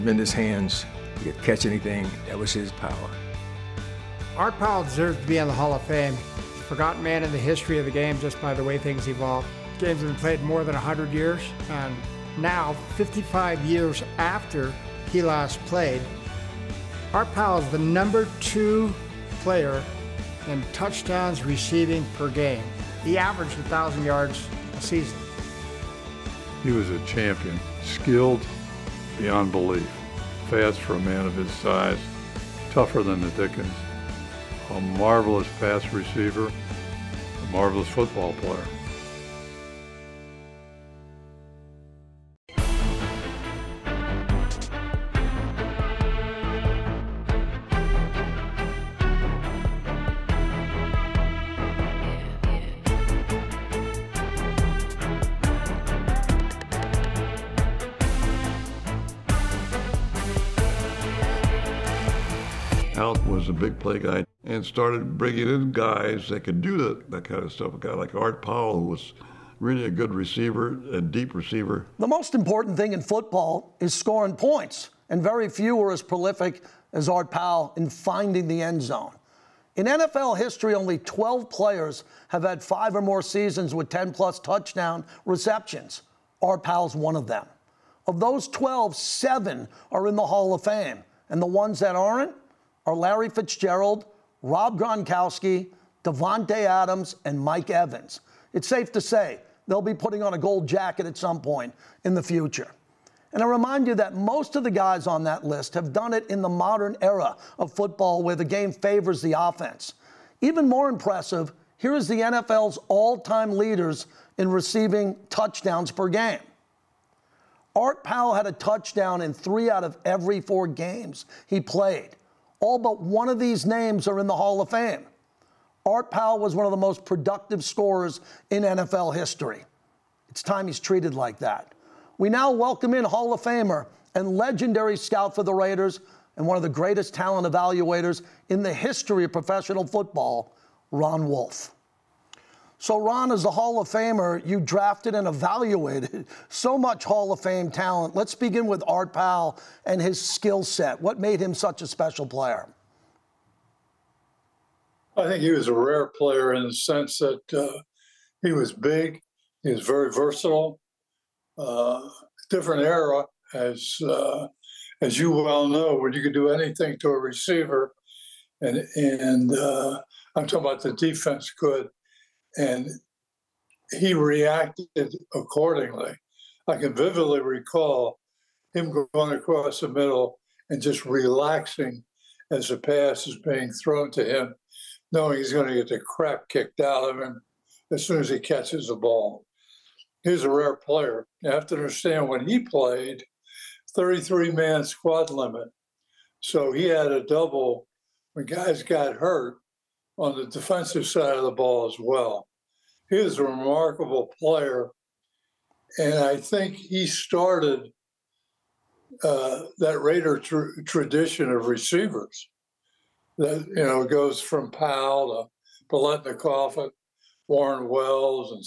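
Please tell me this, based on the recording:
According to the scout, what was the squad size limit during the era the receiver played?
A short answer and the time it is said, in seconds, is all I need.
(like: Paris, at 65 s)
33, at 193 s.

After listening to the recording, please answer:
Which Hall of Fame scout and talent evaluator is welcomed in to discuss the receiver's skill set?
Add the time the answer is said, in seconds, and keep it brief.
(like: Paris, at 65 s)
Ron Wolf, at 140 s.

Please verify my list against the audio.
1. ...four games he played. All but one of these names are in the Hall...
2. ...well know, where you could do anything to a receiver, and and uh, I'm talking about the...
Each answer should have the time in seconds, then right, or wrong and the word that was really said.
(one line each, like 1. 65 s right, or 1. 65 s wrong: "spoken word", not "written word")
1. 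120 s right
2. 165 s right.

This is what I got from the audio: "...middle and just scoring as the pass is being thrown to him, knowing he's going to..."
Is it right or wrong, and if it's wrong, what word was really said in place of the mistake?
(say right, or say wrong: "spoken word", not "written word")
wrong: "relaxing", not "scoring".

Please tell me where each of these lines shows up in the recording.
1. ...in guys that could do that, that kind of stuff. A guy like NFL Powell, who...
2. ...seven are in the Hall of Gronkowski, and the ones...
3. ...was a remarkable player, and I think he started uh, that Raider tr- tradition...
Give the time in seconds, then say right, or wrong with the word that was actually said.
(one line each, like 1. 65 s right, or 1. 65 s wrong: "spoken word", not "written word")
1. 65 s wrong: "Art", not "NFL"
2. 88 s wrong: "Fame", not "Gronkowski"
3. 203 s right.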